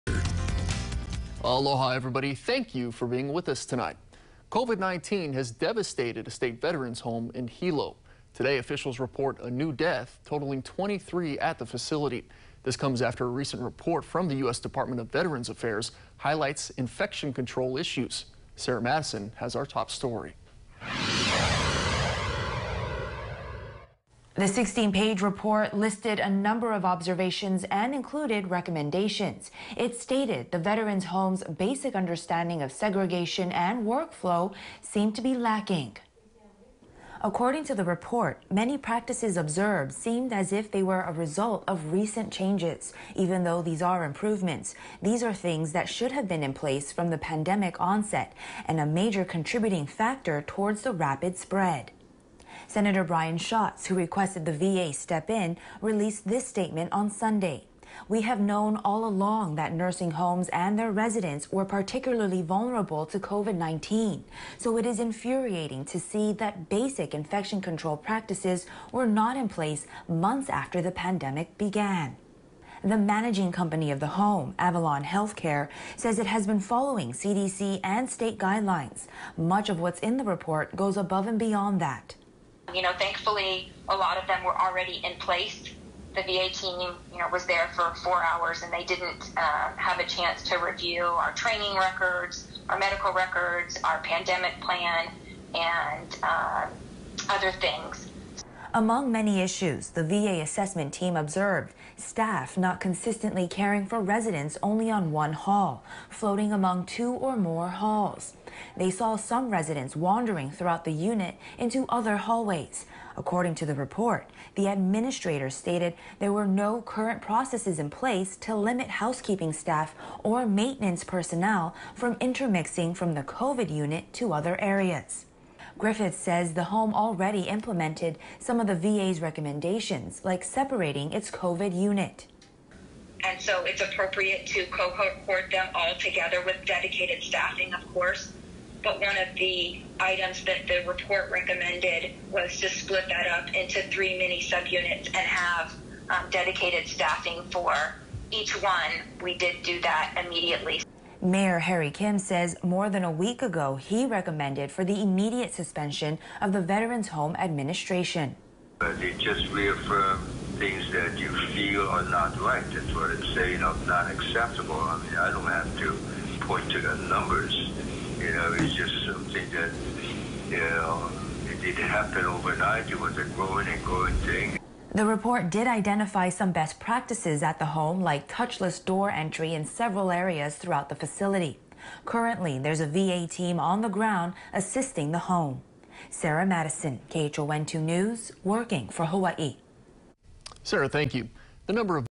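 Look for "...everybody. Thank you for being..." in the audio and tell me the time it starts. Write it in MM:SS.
00:01.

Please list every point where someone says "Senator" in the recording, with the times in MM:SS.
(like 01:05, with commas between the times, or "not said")
00:52.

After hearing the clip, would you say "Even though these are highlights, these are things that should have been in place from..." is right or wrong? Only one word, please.
wrong.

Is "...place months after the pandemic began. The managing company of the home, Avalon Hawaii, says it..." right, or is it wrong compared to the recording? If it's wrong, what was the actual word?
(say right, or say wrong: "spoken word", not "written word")
wrong: "Healthcare", not "Hawaii".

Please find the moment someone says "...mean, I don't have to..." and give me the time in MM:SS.
02:44.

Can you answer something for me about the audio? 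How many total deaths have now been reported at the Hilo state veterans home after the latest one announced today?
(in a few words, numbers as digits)
23.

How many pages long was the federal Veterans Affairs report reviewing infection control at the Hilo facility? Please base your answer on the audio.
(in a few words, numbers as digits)
16.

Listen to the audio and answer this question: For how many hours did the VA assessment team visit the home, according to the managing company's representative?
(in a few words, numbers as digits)
4.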